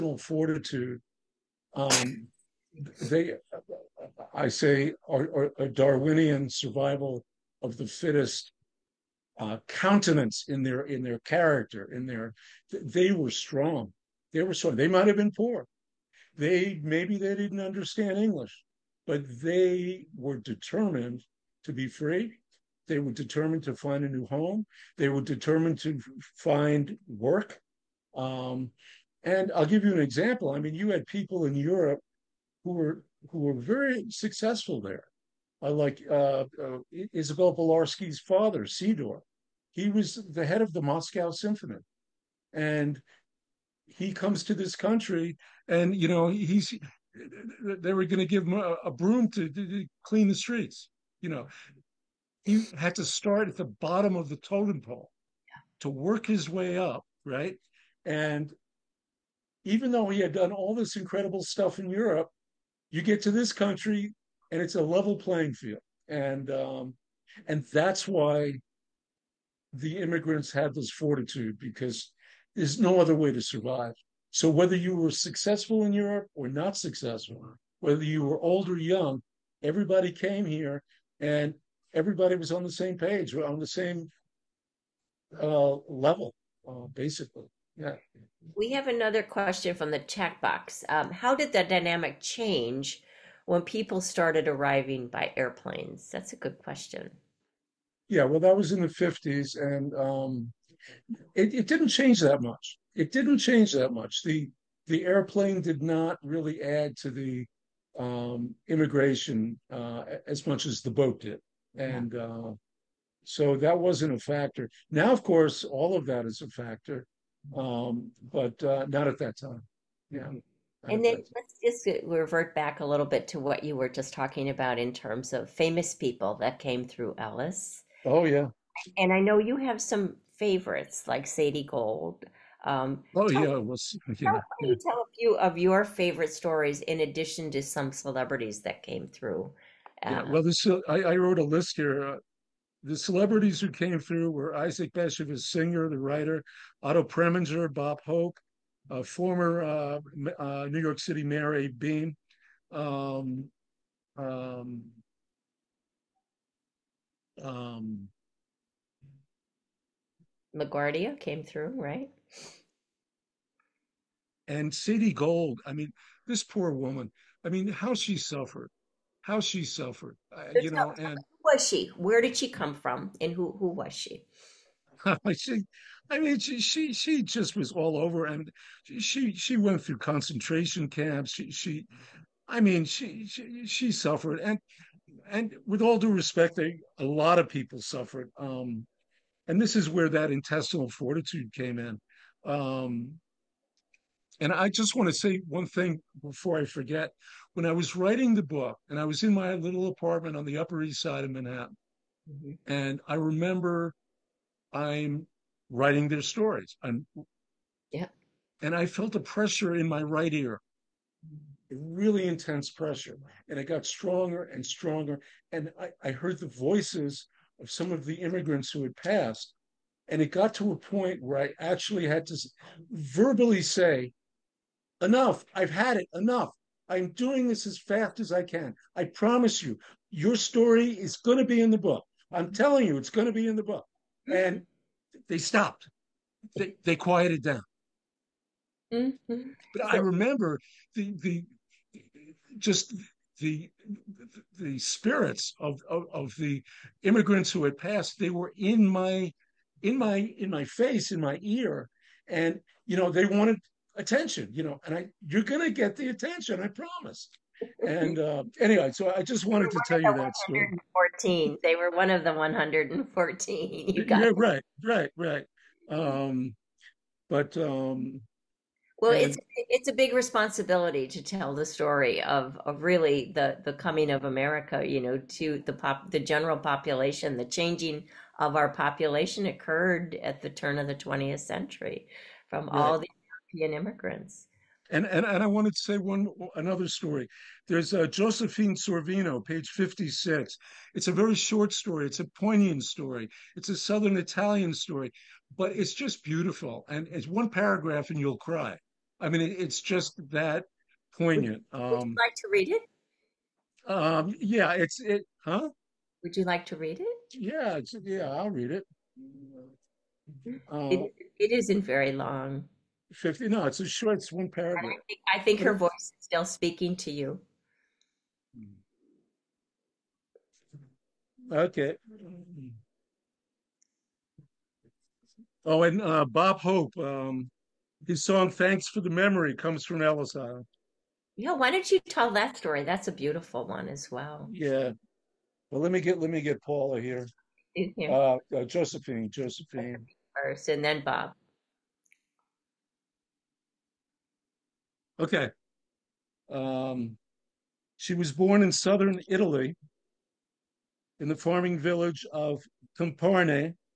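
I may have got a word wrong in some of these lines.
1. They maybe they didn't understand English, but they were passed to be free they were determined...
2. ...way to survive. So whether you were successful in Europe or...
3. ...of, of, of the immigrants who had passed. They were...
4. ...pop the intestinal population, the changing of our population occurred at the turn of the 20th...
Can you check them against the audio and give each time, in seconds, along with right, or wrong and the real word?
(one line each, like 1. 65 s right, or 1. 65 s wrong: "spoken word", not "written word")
1. 16 s wrong: "determined", not "passed"
2. 73 s right
3. 245 s right
4. 275 s wrong: "general", not "intestinal".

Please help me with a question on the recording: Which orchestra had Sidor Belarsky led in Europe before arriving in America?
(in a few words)
Moscow Symphony.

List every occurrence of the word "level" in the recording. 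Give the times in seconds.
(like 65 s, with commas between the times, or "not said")
64 s, 85 s.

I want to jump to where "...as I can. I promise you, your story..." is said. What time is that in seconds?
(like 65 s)
228 s.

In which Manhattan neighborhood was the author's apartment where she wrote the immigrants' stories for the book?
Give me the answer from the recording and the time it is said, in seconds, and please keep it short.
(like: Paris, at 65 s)
Upper East Side, at 200 s.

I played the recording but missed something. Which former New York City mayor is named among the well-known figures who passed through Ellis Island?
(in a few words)
Abe Beame.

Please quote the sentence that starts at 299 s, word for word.
I mean, it, it's just that poignant.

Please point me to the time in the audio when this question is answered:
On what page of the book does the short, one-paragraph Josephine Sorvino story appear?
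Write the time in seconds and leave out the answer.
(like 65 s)
289 s.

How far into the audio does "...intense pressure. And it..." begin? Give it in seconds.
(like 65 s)
212 s.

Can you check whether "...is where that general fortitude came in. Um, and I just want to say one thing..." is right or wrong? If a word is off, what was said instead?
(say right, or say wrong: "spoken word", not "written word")
wrong: "intestinal", not "general".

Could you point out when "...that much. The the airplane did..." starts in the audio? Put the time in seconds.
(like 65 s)
103 s.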